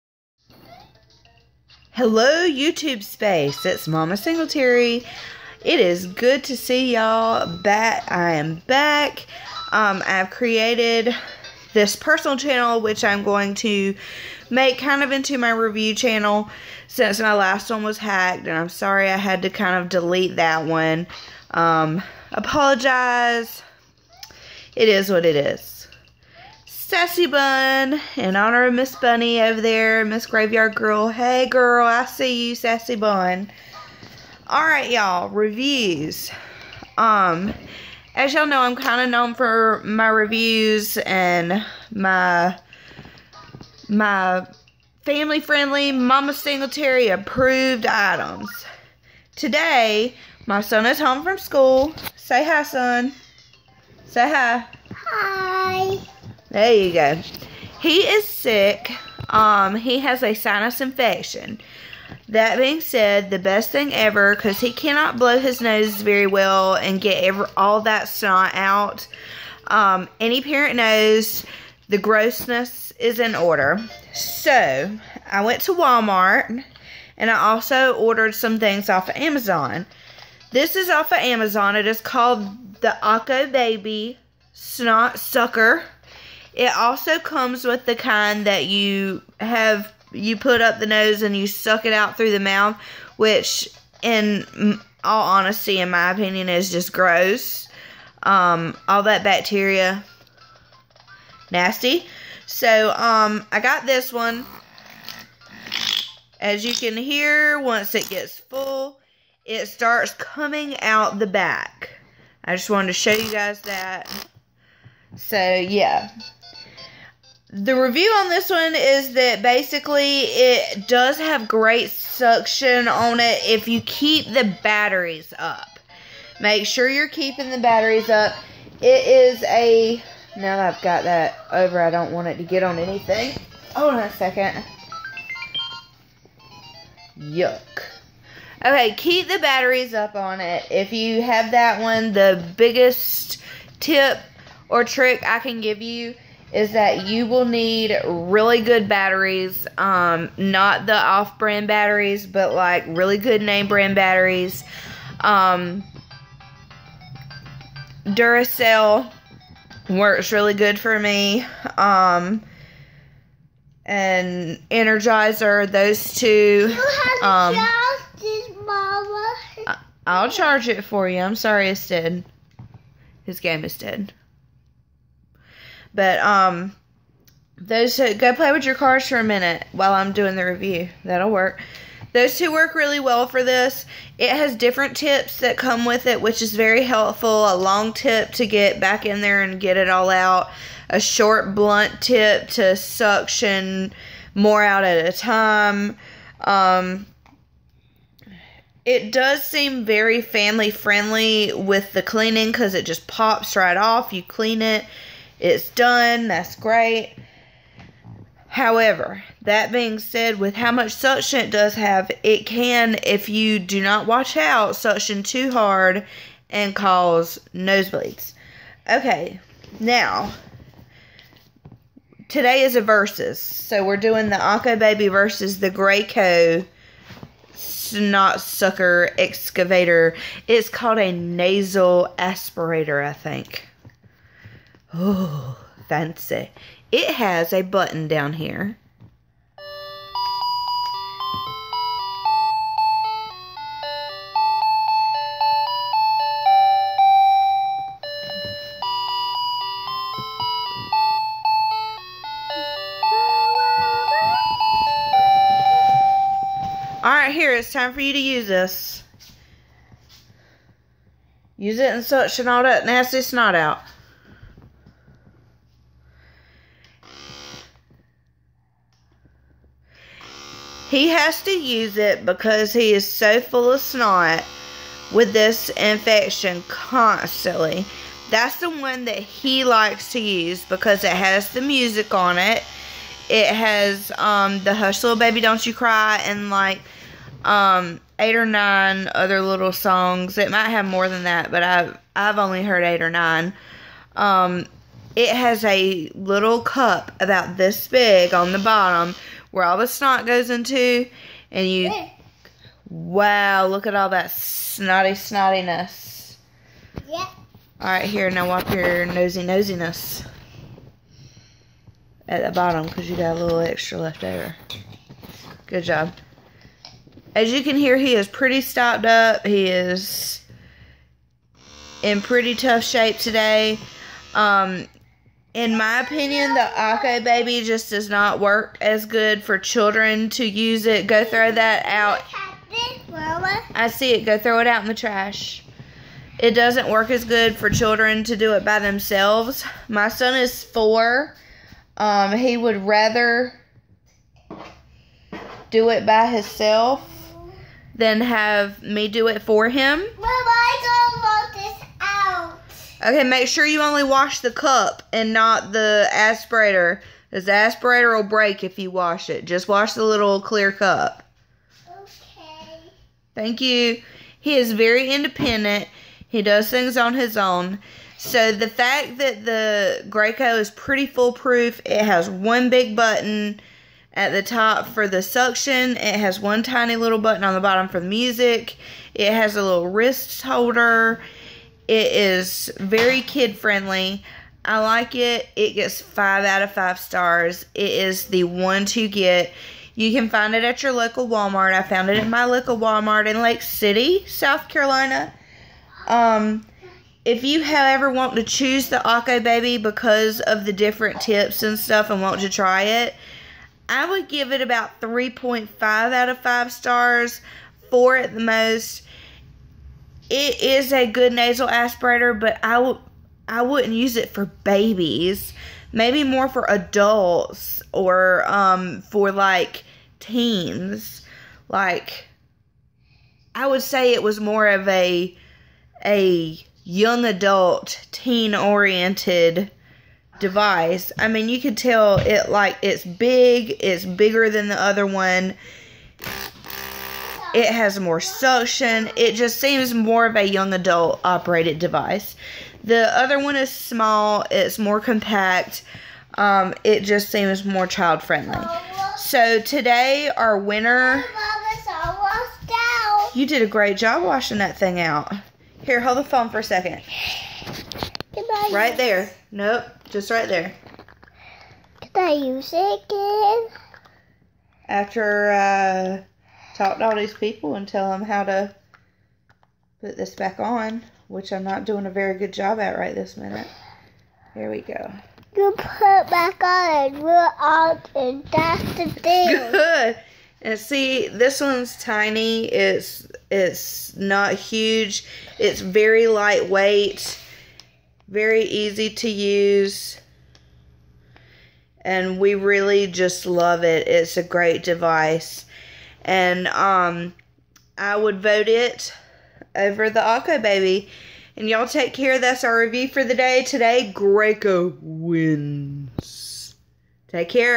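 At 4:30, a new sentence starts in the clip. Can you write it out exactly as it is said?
He has to use it because he is so full of snot with this infection constantly.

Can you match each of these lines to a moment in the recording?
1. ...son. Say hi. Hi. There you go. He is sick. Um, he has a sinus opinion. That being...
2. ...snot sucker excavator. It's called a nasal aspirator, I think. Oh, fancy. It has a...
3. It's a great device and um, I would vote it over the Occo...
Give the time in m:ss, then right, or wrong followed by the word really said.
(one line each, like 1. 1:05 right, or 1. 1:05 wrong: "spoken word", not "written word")
1. 0:52 wrong: "infection", not "opinion"
2. 3:47 right
3. 8:14 right.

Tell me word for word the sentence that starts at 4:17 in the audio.
Alright, here, it's time for you to use this.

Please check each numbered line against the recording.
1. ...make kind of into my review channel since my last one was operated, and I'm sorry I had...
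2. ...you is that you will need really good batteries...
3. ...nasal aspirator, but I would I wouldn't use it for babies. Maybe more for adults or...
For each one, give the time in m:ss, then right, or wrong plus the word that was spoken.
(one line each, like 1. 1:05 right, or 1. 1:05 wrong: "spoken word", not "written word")
1. 0:14 wrong: "hacked", not "operated"
2. 2:25 right
3. 6:51 right.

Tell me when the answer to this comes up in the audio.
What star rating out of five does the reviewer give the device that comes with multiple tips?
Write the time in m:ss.
6:45.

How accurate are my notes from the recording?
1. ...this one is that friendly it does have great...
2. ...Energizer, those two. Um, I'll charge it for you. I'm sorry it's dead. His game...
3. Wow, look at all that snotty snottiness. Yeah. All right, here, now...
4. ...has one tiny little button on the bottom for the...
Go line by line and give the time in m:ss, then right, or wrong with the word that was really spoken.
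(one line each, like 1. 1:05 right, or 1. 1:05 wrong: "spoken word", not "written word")
1. 1:58 wrong: "basically", not "friendly"
2. 2:44 right
3. 5:02 right
4. 6:16 right.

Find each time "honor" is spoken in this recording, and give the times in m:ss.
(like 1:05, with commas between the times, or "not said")
0:28.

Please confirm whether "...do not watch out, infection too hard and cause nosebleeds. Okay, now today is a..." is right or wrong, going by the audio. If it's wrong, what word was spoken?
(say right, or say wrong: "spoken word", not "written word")
wrong: "suction", not "infection".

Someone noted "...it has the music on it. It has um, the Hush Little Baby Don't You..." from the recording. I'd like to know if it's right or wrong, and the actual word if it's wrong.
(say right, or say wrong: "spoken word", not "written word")
right.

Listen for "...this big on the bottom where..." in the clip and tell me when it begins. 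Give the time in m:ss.
4:57.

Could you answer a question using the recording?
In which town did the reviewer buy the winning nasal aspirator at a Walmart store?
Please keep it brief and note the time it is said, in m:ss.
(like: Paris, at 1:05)
Lake City, South Carolina, at 6:33.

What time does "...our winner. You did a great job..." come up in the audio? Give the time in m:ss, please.
7:30.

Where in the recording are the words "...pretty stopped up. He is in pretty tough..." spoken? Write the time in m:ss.
5:18.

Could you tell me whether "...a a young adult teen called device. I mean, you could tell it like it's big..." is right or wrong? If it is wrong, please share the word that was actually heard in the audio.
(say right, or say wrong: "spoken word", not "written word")
wrong: "oriented", not "called".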